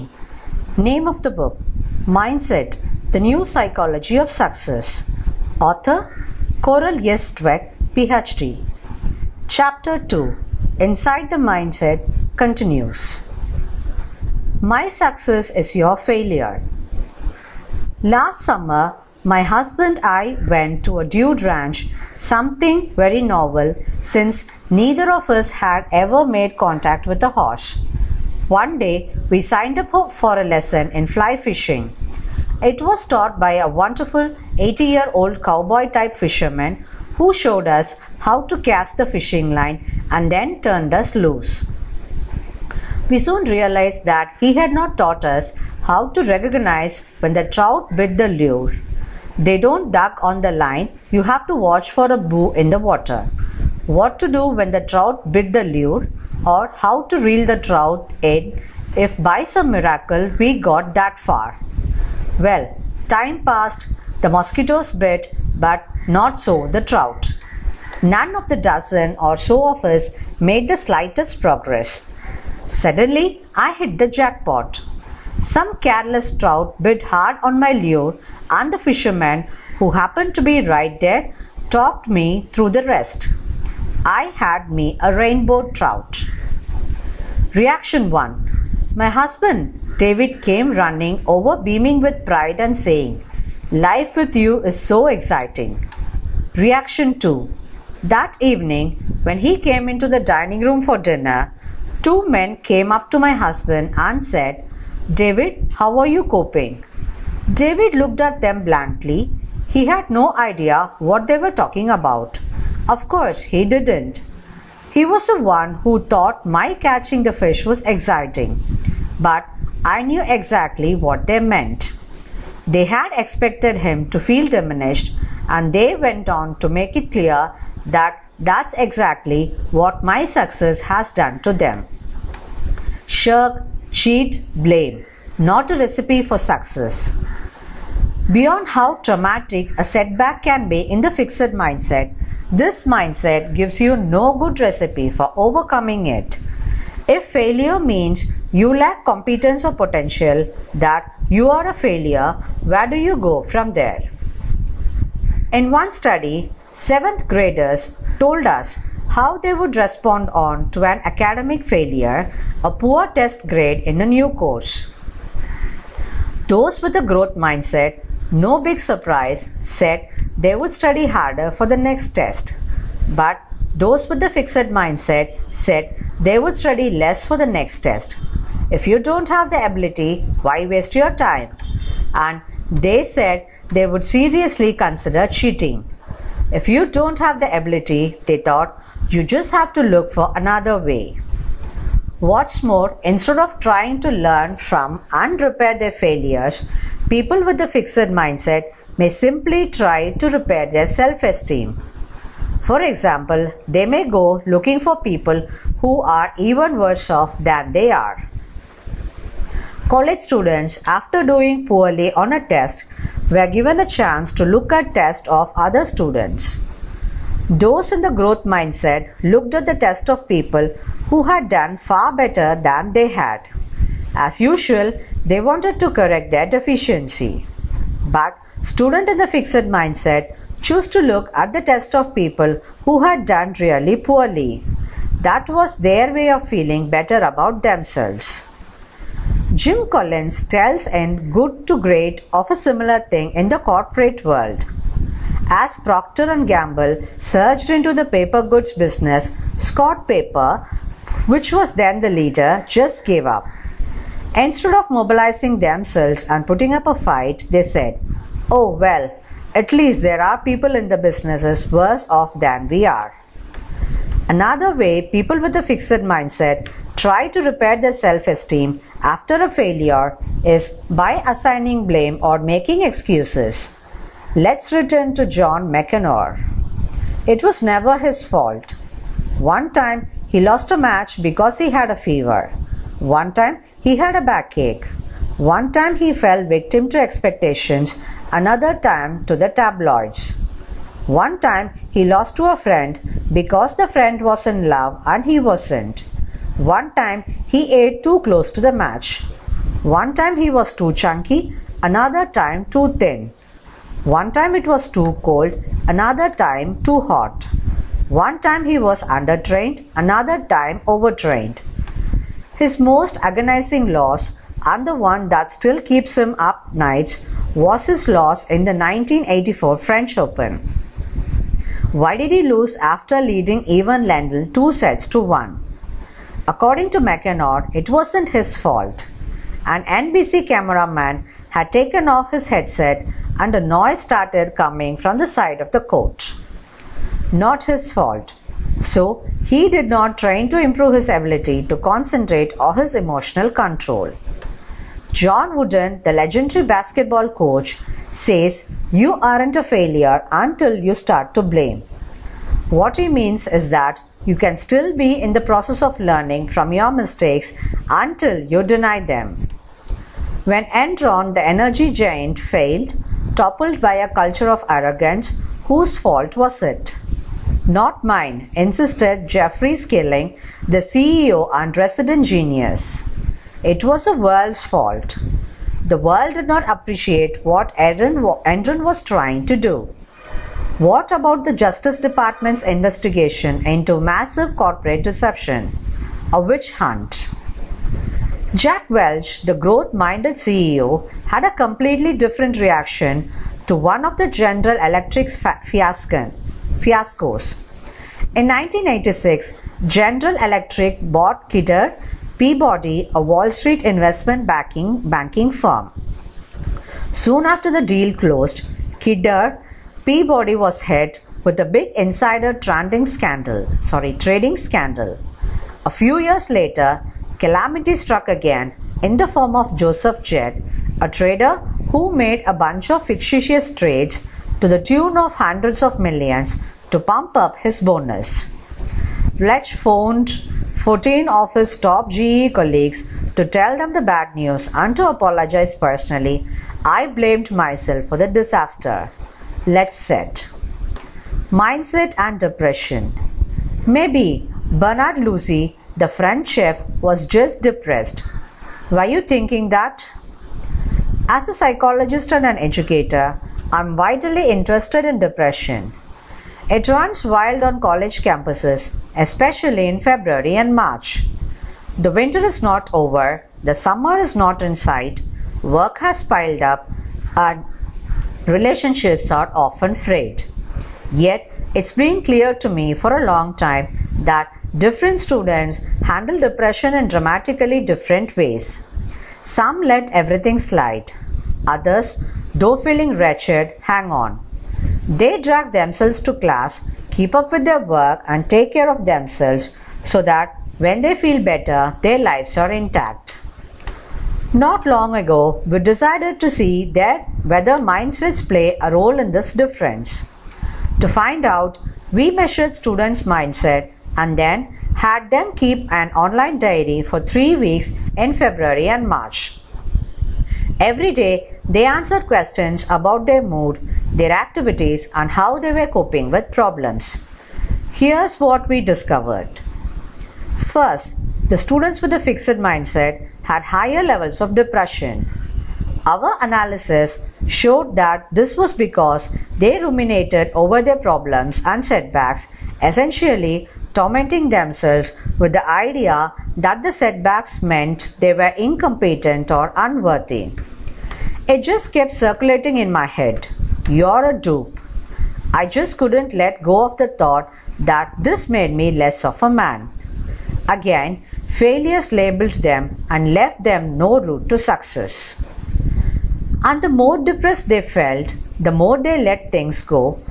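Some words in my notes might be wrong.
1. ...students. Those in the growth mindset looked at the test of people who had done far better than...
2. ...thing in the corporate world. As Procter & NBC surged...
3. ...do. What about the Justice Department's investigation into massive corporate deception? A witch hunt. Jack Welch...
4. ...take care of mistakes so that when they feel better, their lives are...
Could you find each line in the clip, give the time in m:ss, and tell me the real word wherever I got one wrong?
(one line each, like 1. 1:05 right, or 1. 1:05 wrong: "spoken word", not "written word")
1. 3:35 right
2. 4:03 wrong: "Gamble", not "NBC"
3. 6:19 right
4. 8:08 wrong: "themselves", not "mistakes".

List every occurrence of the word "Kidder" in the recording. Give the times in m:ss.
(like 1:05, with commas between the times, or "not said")
6:41, 6:48.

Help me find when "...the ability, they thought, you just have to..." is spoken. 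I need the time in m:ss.
3:07.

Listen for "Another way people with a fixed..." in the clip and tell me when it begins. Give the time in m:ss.
4:24.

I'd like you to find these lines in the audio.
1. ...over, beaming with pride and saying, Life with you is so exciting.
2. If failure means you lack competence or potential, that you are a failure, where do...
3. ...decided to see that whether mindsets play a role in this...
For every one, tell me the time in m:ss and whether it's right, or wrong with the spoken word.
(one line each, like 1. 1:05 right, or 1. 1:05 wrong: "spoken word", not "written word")
1. 1:31 right
2. 2:27 right
3. 8:15 right.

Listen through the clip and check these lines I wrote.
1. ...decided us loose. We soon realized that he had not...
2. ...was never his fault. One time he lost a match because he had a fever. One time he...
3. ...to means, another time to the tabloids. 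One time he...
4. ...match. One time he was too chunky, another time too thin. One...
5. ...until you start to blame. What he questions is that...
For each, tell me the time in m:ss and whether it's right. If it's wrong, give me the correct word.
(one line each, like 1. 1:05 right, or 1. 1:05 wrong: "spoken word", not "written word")
1. 0:40 wrong: "turned", not "decided"
2. 4:37 right
3. 4:46 wrong: "expectations", not "means"
4. 4:58 right
5. 5:50 wrong: "means", not "questions".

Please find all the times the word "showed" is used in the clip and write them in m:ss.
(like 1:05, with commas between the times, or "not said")
0:37, 8:47.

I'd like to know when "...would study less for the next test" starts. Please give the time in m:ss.
2:56.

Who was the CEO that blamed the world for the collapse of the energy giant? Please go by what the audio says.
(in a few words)
Jeffrey Skilling.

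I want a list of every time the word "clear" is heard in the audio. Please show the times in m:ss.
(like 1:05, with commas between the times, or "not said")
2:07, 7:52.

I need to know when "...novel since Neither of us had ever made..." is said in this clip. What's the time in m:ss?
0:23.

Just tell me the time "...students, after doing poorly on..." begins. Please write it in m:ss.
3:30.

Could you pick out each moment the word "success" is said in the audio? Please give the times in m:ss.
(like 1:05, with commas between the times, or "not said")
0:04, 0:14, 2:10, 2:16, 9:14.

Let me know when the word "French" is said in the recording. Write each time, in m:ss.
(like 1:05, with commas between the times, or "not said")
5:19, 7:26.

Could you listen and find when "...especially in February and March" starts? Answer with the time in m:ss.
7:39.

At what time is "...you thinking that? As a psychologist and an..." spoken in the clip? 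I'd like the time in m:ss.
7:29.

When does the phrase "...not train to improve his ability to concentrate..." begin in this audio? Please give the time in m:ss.
5:39.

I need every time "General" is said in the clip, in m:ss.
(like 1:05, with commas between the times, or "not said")
6:34, 6:39.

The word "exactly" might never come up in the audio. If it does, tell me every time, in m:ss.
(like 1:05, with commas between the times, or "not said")
2:00, 2:08.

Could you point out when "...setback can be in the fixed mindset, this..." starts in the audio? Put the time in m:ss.
2:19.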